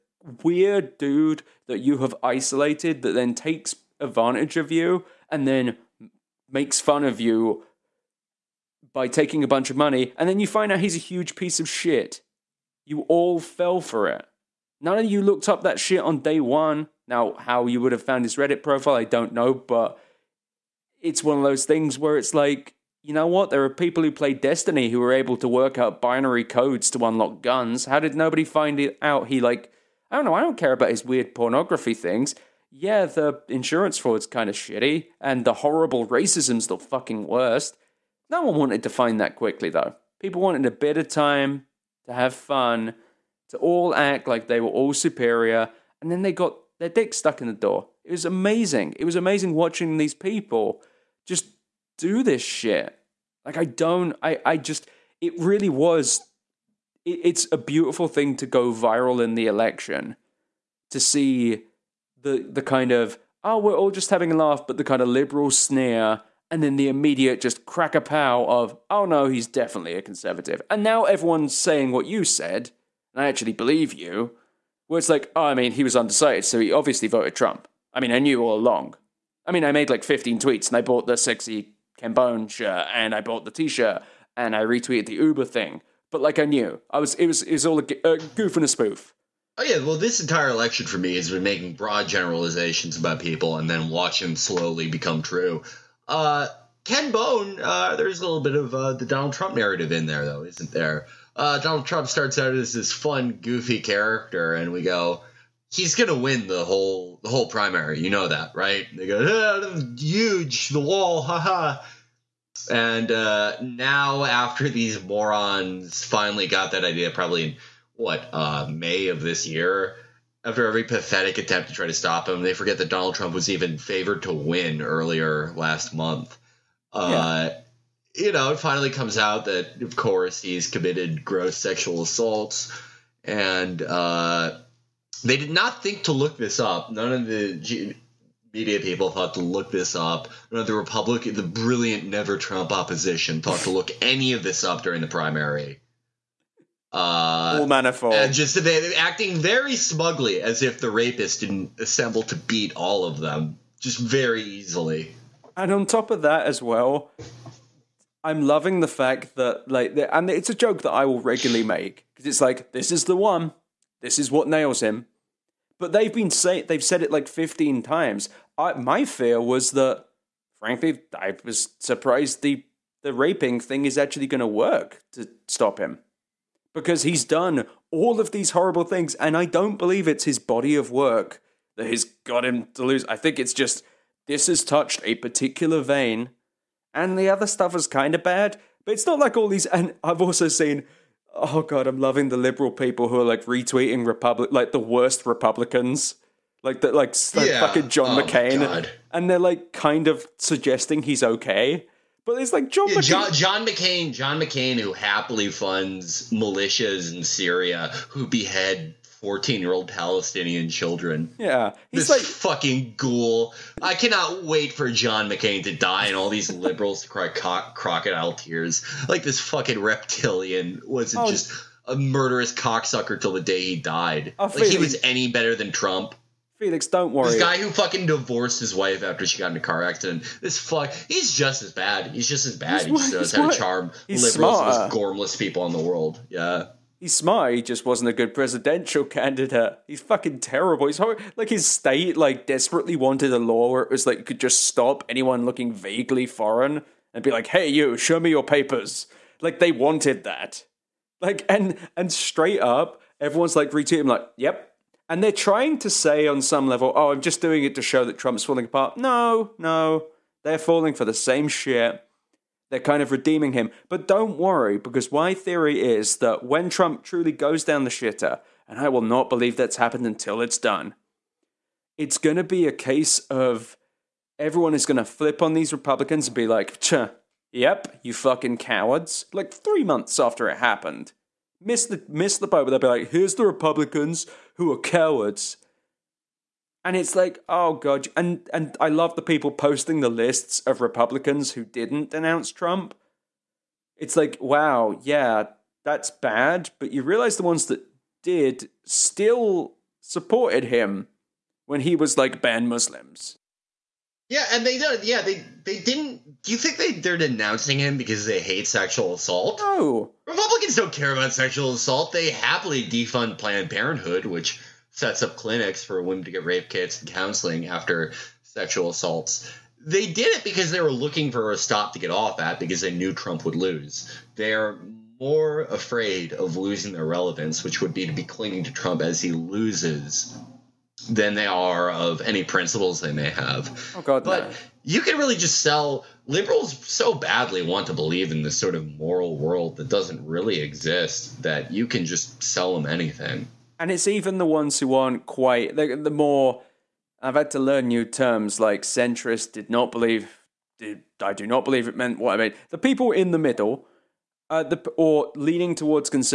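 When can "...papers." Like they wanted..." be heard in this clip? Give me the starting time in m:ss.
4:08.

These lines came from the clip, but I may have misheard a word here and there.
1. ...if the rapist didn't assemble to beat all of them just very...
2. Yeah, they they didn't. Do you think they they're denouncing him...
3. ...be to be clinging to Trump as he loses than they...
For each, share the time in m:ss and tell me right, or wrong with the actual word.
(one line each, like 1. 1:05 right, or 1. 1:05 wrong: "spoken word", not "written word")
1. 2:30 right
2. 5:05 right
3. 5:27 right.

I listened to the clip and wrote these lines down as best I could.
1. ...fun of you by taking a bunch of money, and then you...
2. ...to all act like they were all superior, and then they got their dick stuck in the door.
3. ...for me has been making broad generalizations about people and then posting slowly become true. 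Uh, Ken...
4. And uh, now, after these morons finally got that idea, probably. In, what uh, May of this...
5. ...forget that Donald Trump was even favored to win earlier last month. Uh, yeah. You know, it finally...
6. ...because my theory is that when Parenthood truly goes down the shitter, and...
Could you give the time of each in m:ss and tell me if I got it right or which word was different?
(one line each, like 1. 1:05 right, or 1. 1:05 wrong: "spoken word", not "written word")
1. 0:06 right
2. 0:43 right
3. 1:30 wrong: "watching", not "posting"
4. 1:52 right
5. 2:02 right
6. 4:24 wrong: "Trump", not "Parenthood".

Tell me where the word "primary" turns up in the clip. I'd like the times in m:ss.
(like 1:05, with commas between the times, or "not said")
1:47, 2:25.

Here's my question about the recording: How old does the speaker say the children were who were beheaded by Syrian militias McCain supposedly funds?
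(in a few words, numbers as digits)
14.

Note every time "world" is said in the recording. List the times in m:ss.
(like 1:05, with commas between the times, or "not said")
3:55, 5:39.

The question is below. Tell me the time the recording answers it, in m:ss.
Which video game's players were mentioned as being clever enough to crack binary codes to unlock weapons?
0:24.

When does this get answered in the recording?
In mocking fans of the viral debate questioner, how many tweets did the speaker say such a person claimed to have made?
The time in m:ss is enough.
1:20.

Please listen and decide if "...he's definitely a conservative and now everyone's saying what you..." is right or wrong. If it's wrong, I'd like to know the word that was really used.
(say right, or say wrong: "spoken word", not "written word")
right.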